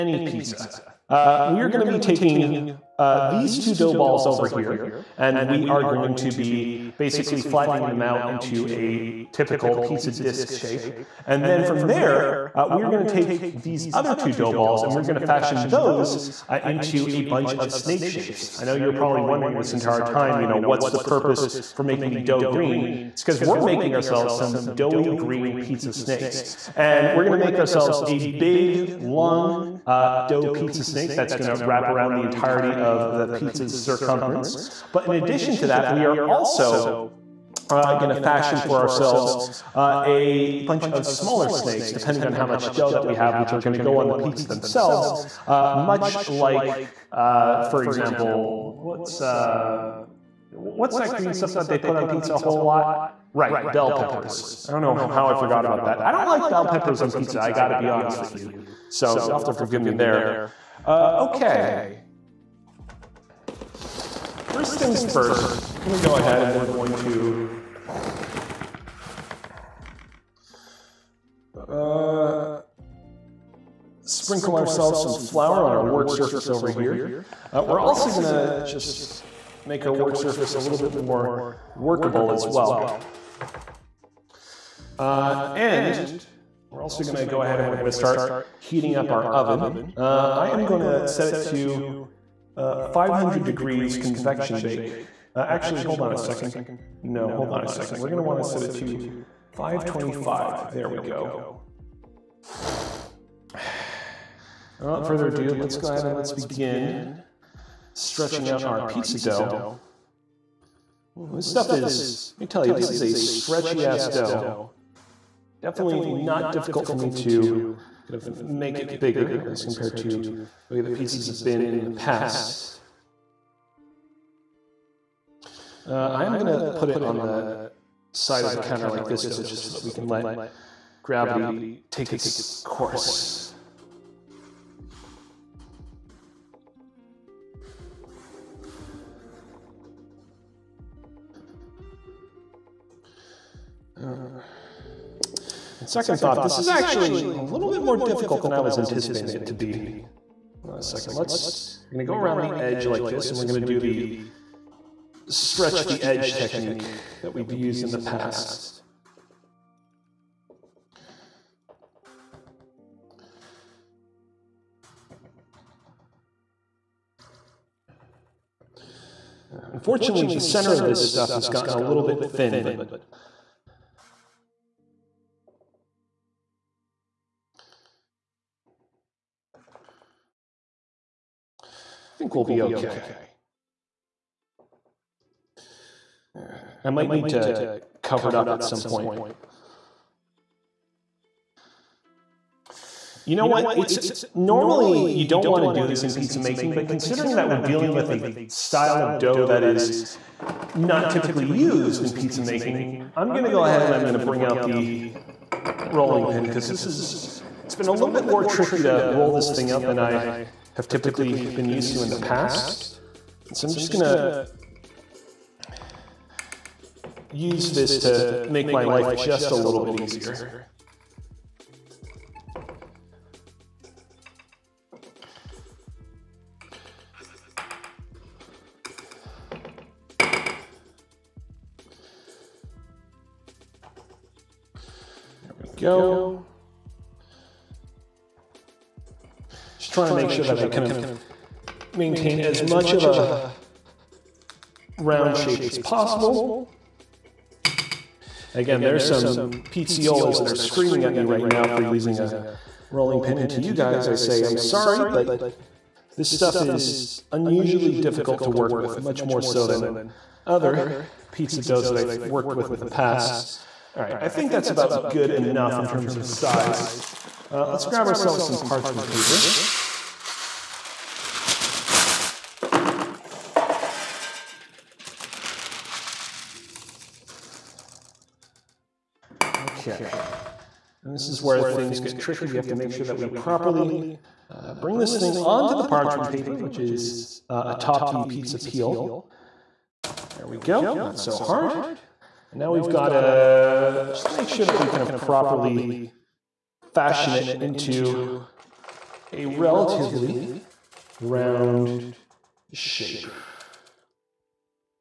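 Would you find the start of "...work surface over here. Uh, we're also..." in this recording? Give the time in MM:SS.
01:15.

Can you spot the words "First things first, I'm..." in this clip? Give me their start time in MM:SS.
01:04.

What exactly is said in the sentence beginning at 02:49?
Unfortunately, the center of this stuff has gotten a little bit thin, but I think we'll be okay.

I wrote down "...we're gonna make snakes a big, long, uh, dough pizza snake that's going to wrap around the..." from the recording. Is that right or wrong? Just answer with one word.
wrong.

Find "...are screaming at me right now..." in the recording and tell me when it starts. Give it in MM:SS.
04:10.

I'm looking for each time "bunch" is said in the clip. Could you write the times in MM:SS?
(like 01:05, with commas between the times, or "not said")
00:17, 00:40.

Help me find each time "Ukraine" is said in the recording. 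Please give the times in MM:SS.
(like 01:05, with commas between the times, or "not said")
not said.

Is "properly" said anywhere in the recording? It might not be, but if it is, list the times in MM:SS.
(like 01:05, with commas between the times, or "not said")
04:43, 04:55.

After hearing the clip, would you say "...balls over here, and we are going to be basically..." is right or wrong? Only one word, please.
right.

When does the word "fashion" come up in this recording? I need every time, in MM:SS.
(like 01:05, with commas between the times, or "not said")
00:15, 00:38, 04:56.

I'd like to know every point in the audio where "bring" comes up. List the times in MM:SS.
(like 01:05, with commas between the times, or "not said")
03:24, 04:44.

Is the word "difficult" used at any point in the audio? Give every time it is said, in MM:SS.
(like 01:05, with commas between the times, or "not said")
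01:56, 02:27, 04:17.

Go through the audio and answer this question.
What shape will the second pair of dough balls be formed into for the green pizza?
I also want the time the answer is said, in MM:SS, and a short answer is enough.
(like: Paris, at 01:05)
Snake shapes, at 00:17.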